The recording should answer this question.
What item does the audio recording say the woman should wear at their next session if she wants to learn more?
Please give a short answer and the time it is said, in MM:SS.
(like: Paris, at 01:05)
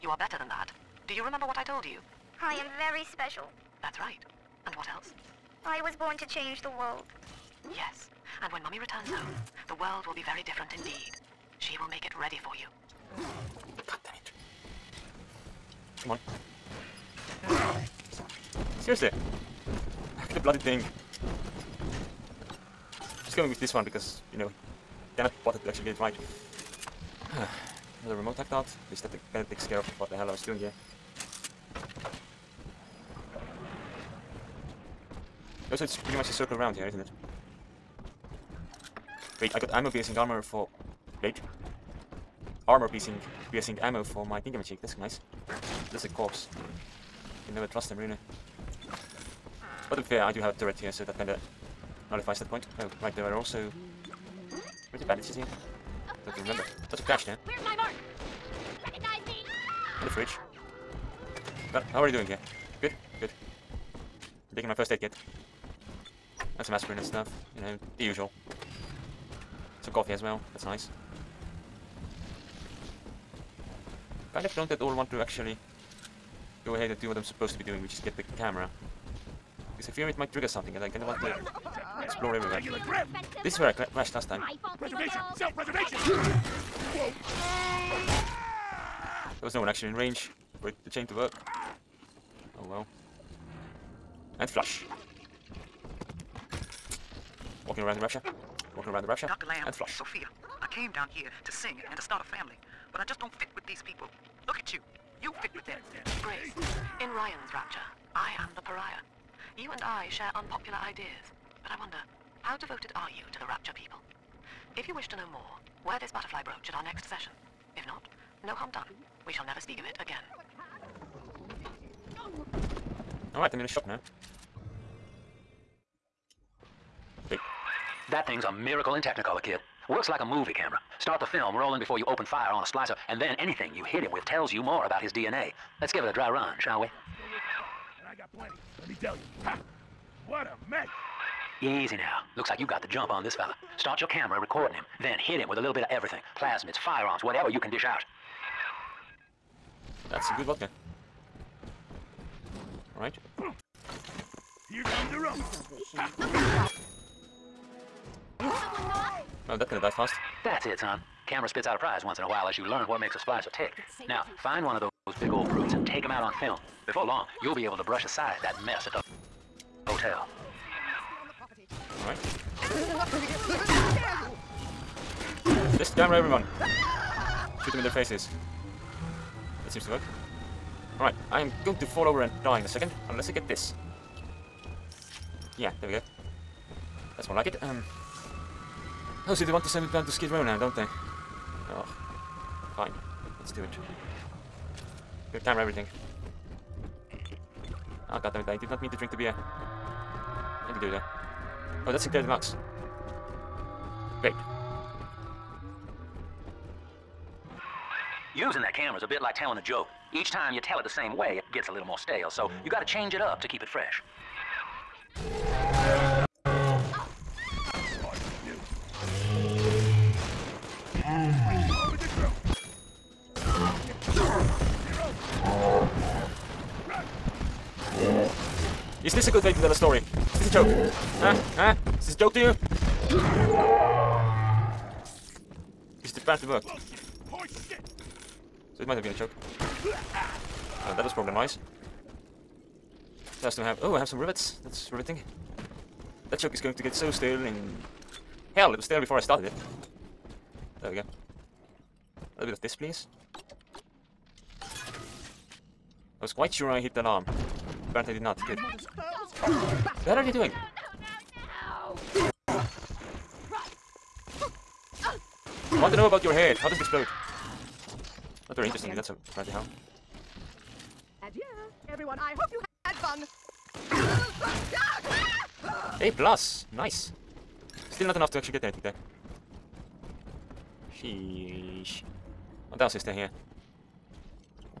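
butterfly brooch, at 01:56.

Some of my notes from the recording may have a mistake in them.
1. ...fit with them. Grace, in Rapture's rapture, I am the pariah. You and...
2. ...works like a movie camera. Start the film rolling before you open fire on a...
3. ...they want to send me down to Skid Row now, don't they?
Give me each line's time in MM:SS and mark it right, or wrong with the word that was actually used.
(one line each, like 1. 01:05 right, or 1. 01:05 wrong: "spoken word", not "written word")
1. 01:45 wrong: "Ryan", not "Rapture"
2. 02:09 right
3. 03:09 right.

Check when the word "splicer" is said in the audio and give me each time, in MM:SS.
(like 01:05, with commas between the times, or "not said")
02:12, 02:43.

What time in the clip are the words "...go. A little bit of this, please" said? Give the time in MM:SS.
04:10.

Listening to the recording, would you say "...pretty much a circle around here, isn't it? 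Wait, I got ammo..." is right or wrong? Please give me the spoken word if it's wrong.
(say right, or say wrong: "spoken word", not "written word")
right.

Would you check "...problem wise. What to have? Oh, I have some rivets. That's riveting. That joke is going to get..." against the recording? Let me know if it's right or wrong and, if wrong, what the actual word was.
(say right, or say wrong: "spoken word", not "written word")
right.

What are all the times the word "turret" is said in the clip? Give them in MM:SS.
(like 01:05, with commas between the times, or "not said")
00:50.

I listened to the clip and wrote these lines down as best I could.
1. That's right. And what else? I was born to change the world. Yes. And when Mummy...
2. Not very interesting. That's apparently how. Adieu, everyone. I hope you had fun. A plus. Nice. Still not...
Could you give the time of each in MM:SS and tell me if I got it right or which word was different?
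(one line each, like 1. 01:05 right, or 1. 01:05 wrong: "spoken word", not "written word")
1. 00:03 right
2. 04:28 right.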